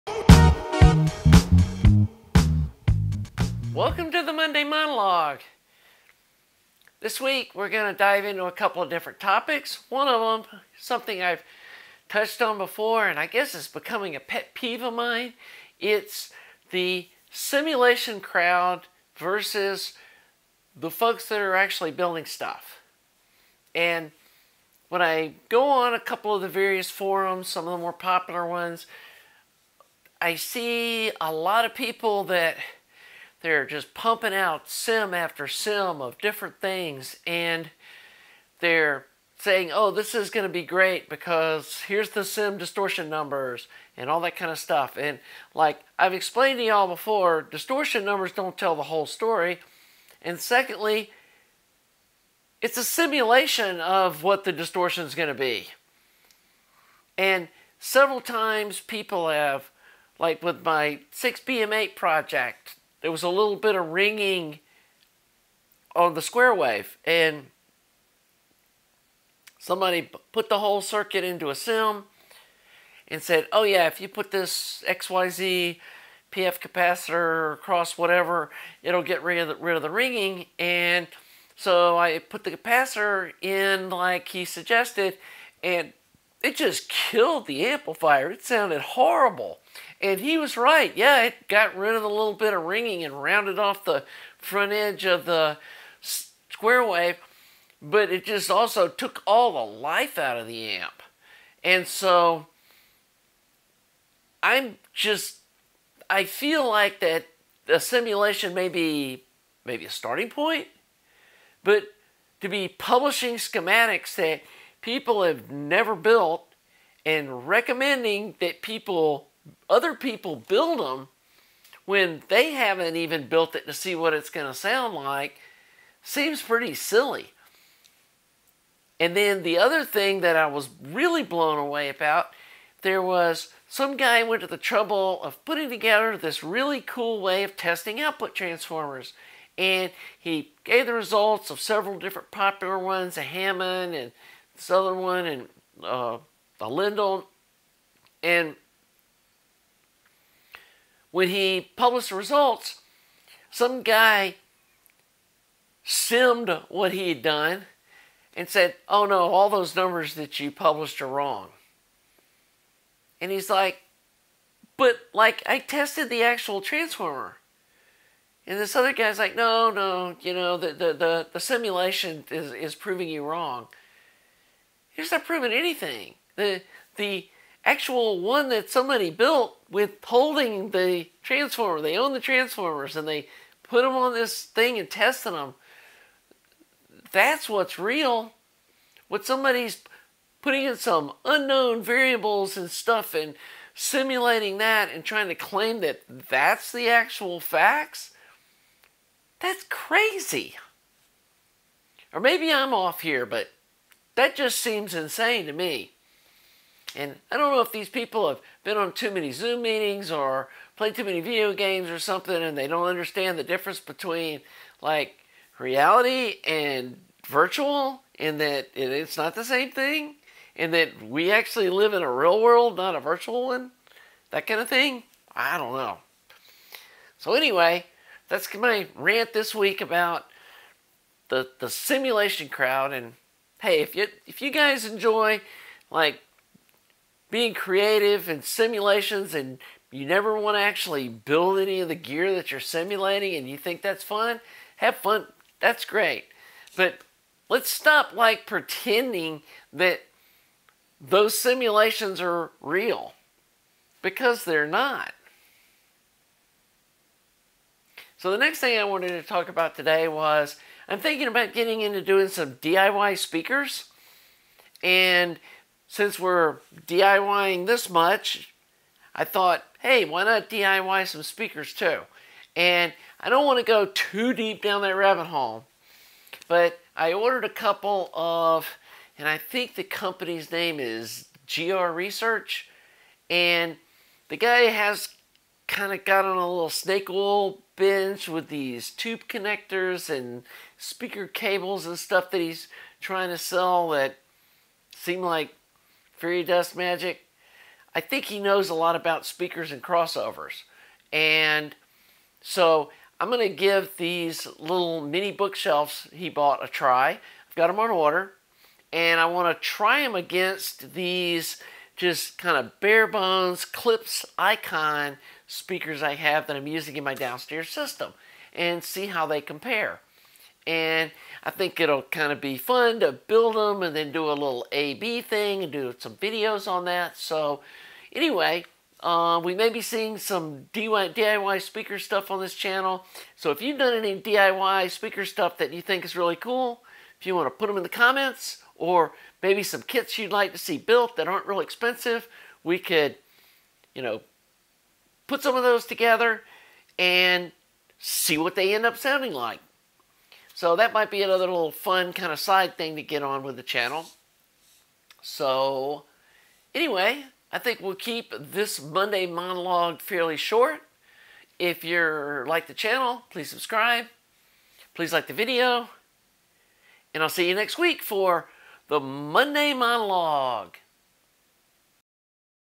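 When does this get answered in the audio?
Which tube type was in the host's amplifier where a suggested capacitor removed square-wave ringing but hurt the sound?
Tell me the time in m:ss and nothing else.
1:01.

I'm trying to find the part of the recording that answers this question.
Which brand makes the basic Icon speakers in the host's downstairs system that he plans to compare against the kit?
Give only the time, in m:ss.
5:13.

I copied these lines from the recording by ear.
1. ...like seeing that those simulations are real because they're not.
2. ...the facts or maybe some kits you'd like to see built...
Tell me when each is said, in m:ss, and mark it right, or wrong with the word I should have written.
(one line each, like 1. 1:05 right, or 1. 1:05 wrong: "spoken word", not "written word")
1. 4:08 wrong: "pretending", not "seeing"
2. 5:37 wrong: "comments", not "facts".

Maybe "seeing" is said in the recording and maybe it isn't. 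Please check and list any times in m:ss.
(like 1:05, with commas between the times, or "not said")
5:29.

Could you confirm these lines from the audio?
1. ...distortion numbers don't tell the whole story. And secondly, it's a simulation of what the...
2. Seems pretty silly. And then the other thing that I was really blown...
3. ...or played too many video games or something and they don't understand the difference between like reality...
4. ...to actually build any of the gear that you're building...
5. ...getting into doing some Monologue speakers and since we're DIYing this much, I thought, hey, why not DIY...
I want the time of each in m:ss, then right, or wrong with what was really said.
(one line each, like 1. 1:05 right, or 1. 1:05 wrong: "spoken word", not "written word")
1. 0:47 right
2. 2:06 right
3. 3:30 right
4. 4:00 wrong: "simulating", not "building"
5. 4:21 wrong: "DIY", not "Monologue".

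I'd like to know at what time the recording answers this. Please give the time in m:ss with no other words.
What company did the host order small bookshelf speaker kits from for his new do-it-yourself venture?
4:41.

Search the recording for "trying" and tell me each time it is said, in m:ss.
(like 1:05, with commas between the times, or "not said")
3:15, 4:53.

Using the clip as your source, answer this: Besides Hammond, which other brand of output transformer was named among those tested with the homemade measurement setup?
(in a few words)
Lundahl.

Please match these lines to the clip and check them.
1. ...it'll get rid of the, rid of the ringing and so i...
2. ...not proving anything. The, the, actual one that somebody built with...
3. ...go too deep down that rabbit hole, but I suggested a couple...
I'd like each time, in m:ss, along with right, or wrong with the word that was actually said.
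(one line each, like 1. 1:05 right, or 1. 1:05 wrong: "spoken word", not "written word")
1. 1:18 right
2. 2:55 right
3. 4:33 wrong: "ordered", not "suggested".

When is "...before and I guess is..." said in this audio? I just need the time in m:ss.
0:12.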